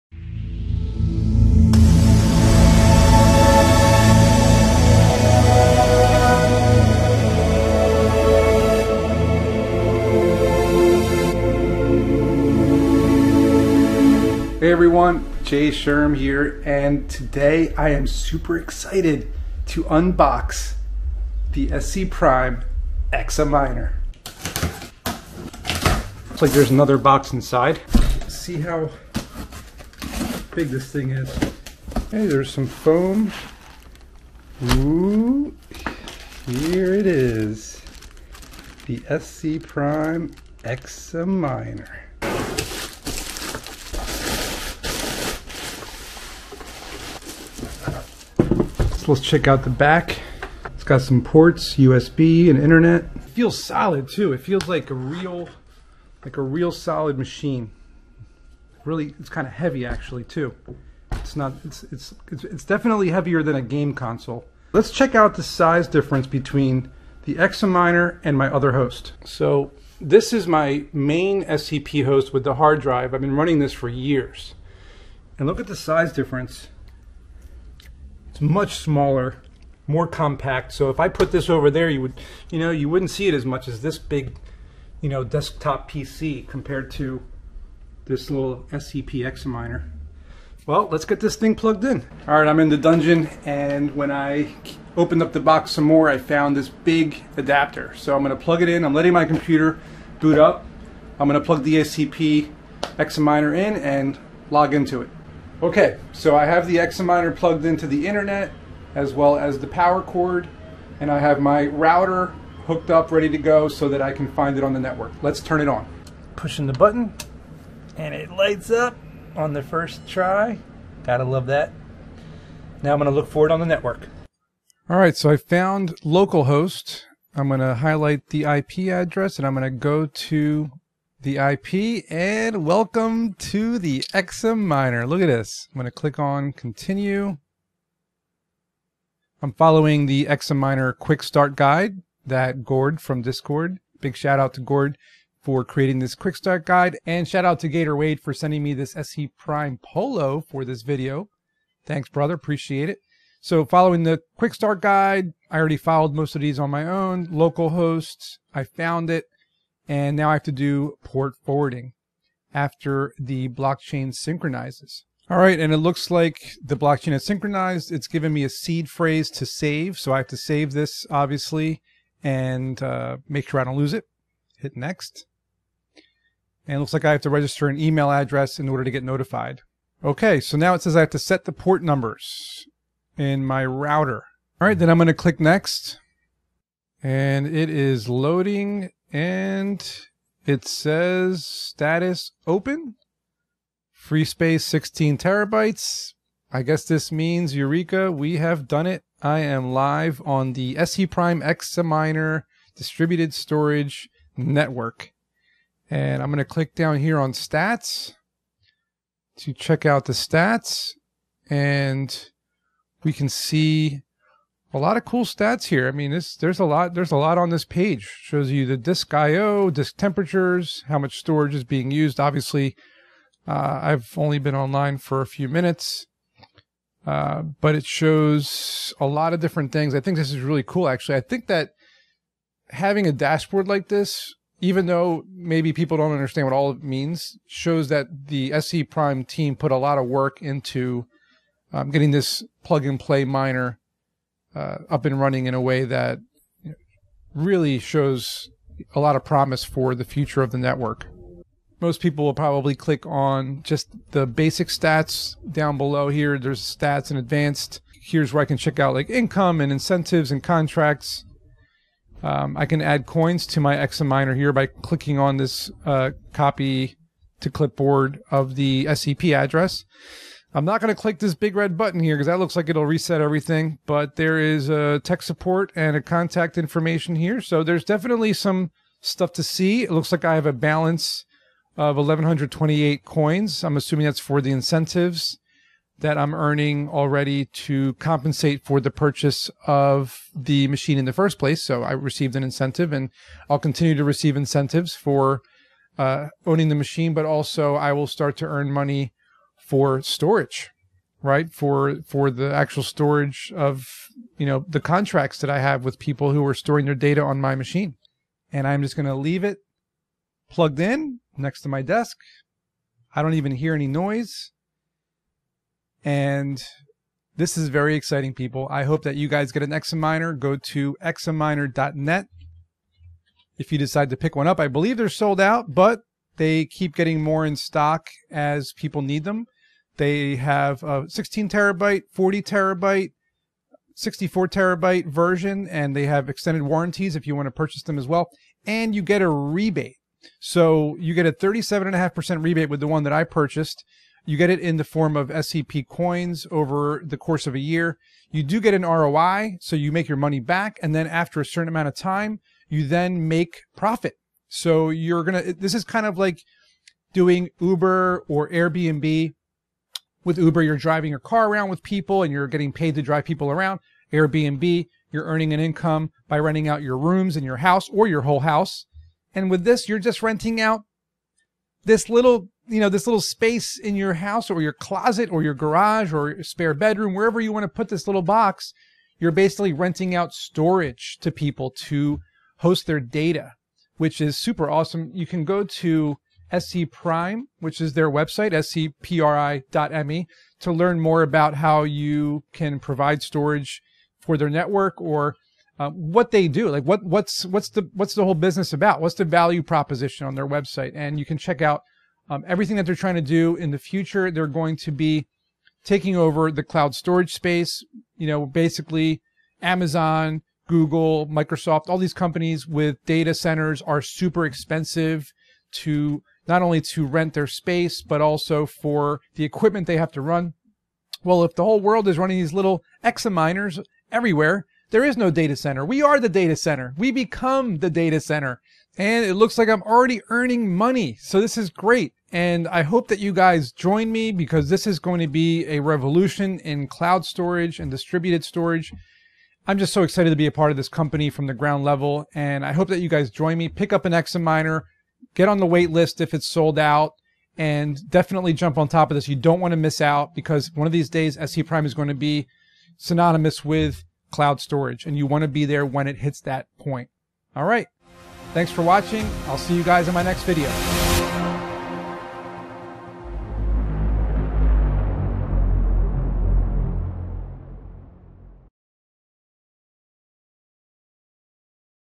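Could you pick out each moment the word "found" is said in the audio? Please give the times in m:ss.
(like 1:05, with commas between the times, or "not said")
1:36, 2:05, 2:38.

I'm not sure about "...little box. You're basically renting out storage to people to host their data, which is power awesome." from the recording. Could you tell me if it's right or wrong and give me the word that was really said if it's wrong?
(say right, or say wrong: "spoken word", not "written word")
wrong: "super", not "power".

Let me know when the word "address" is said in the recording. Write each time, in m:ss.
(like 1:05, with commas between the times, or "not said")
2:08, 2:58, 4:29.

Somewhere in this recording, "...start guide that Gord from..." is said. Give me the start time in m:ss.
2:21.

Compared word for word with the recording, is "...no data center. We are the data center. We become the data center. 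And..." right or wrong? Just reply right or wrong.
right.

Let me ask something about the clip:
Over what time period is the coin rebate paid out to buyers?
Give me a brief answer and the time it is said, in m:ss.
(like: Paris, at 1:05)
a year, at 5:47.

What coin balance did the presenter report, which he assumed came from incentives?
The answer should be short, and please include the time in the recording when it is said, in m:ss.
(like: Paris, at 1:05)
1128, at 4:41.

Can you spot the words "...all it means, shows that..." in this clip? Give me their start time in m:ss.
3:56.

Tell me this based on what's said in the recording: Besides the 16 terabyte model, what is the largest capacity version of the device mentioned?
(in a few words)
64 terabytes.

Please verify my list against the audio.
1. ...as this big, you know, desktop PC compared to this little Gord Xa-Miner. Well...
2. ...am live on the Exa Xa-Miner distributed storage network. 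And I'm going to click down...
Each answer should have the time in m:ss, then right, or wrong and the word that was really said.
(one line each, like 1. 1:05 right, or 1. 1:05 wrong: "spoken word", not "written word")
1. 1:23 wrong: "SCP", not "Gord"
2. 3:19 wrong: "ScPrime", not "Exa".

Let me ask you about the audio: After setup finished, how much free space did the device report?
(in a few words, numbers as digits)
16 terabytes.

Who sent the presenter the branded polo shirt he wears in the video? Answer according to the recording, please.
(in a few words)
Gator Wade.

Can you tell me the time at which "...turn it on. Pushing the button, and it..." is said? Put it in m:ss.
1:55.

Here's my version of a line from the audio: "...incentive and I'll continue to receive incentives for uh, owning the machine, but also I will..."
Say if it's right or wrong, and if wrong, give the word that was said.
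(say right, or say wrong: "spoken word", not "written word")
right.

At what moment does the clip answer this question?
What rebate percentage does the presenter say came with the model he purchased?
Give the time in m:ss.
5:41.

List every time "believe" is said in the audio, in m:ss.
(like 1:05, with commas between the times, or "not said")
5:24.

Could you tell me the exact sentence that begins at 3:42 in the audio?
Obviously, uh, I've only been online for a few minutes, uh, but it shows a lot of different things.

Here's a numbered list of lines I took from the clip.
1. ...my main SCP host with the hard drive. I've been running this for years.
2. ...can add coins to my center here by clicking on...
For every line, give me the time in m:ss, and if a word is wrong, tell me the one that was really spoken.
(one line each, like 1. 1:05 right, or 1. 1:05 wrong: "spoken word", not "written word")
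1. 1:10 right
2. 4:22 wrong: "miner", not "center".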